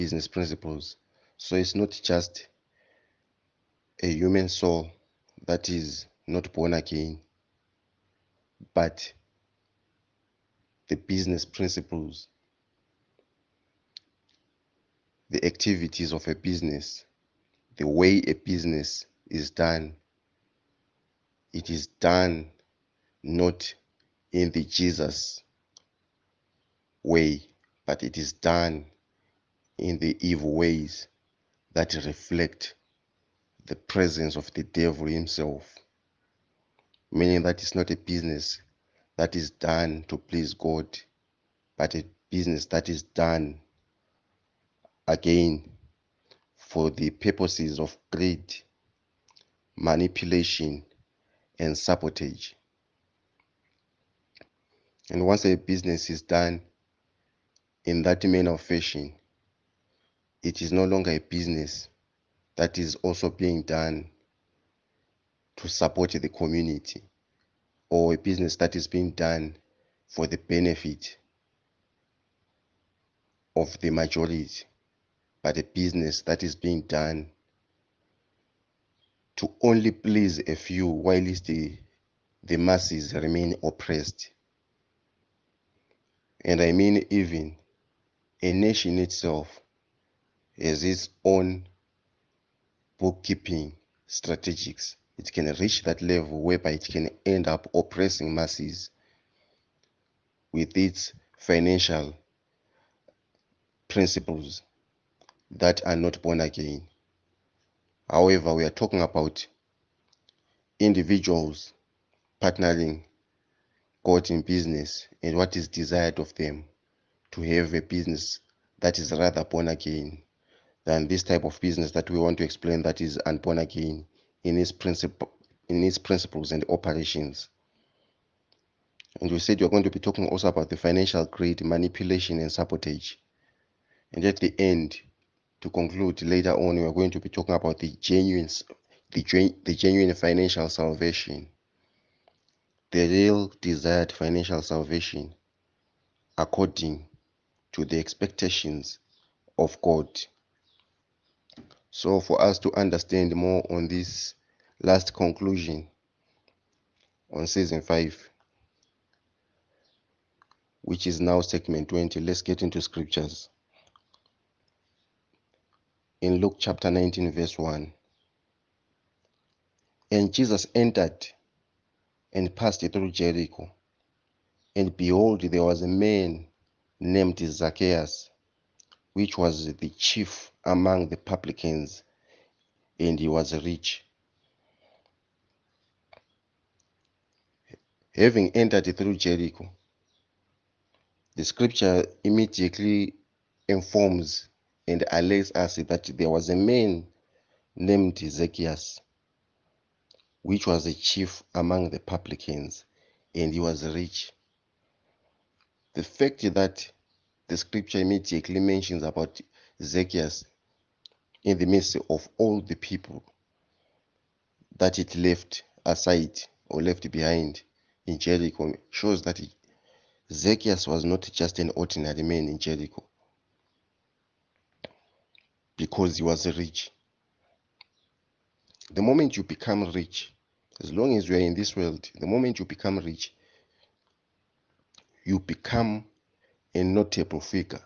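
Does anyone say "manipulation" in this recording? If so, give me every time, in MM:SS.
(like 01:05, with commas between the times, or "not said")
00:49, 02:11.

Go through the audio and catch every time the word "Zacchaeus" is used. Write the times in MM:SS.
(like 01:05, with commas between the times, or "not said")
02:57, 03:18, 03:29, 03:40.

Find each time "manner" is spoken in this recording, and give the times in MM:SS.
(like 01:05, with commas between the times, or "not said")
00:58.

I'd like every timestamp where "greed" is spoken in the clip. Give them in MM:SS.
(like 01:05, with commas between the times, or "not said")
00:48, 02:11.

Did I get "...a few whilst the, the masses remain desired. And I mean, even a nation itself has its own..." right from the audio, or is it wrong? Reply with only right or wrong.
wrong.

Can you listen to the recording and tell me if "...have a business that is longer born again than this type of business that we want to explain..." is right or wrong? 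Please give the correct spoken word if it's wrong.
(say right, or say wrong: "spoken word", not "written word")
wrong: "rather", not "longer".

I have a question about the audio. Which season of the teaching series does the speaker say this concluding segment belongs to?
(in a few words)
5.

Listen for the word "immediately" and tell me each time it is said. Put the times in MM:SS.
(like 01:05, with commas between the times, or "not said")
03:12, 03:27.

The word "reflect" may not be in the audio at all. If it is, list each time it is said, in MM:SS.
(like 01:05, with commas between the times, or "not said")
00:32.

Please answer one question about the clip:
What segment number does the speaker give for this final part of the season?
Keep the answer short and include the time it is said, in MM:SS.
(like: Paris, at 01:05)
20, at 02:41.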